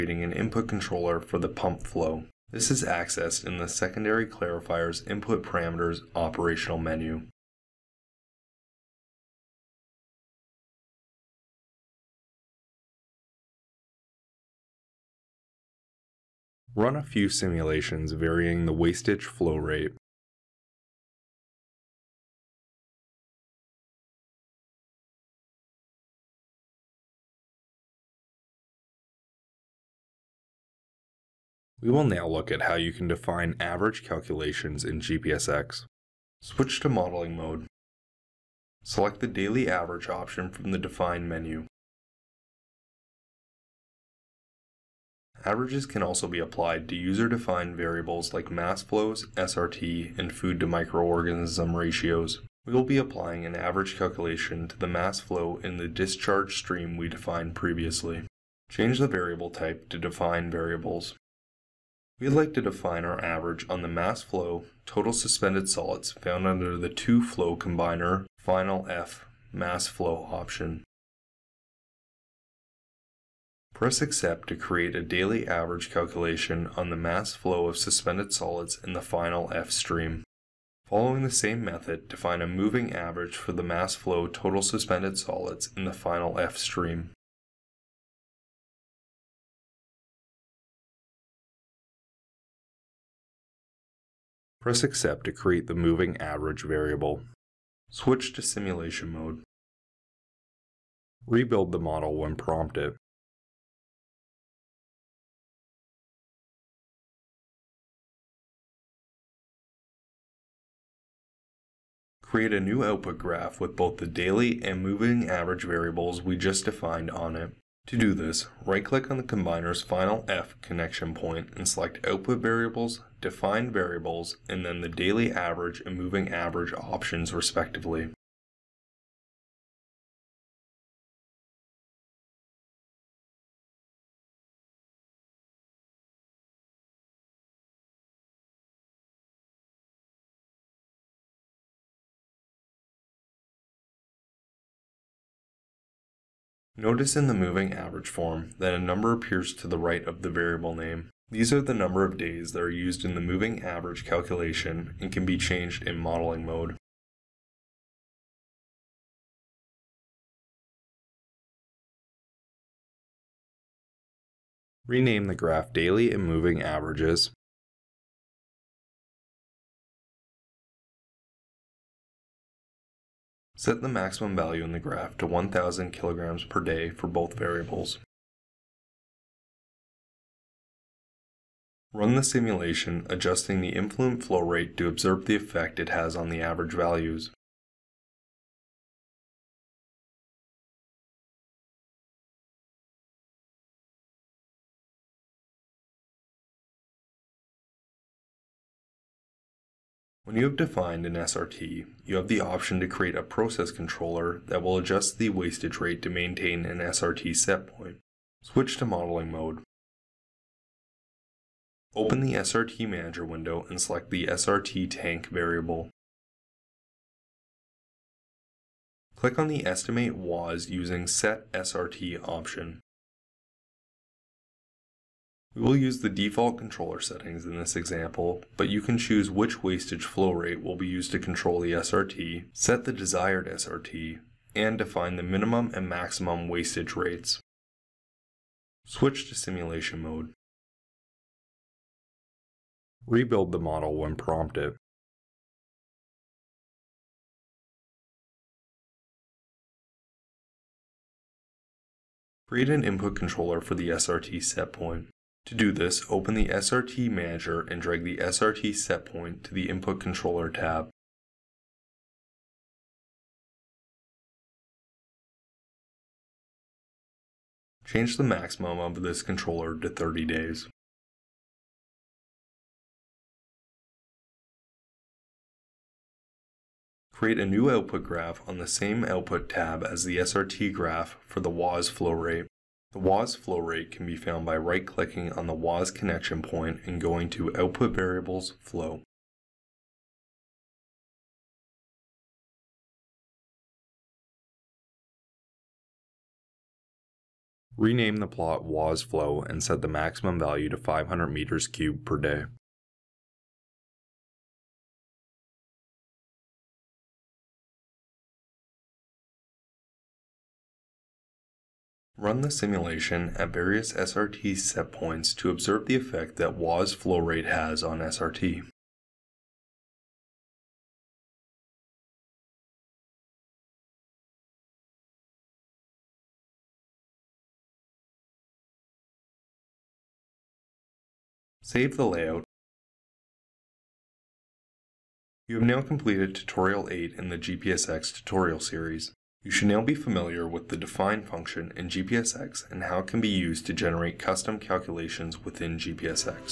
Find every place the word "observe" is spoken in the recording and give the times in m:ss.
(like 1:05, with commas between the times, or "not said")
3:04, 5:15.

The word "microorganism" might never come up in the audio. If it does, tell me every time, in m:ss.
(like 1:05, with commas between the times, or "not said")
0:50.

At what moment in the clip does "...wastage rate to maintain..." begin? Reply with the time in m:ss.
3:25.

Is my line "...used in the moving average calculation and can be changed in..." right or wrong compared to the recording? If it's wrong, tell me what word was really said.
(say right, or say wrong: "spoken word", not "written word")
right.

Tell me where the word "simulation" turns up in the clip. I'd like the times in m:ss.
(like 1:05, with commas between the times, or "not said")
0:17, 1:38, 3:02, 3:59, 5:12.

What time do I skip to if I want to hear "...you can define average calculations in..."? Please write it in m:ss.
0:32.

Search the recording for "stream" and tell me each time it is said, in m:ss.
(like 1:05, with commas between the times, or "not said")
0:56, 1:19, 1:26.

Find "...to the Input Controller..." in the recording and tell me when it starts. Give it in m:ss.
4:19.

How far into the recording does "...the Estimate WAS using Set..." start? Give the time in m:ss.
3:39.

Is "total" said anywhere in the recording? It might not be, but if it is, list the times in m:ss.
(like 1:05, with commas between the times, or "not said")
1:04, 1:24.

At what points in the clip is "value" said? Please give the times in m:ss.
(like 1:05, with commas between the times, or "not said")
2:54, 3:06, 5:00.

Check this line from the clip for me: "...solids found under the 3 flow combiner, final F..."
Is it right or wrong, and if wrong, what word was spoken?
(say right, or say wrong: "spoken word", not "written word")
wrong: "2", not "3".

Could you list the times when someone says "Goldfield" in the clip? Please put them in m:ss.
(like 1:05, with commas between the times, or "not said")
not said.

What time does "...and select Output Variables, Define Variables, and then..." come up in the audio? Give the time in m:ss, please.
2:01.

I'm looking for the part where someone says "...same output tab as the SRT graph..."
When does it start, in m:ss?
4:38.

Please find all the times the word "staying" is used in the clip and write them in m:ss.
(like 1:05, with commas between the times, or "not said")
not said.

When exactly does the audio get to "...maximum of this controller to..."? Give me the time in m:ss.
4:28.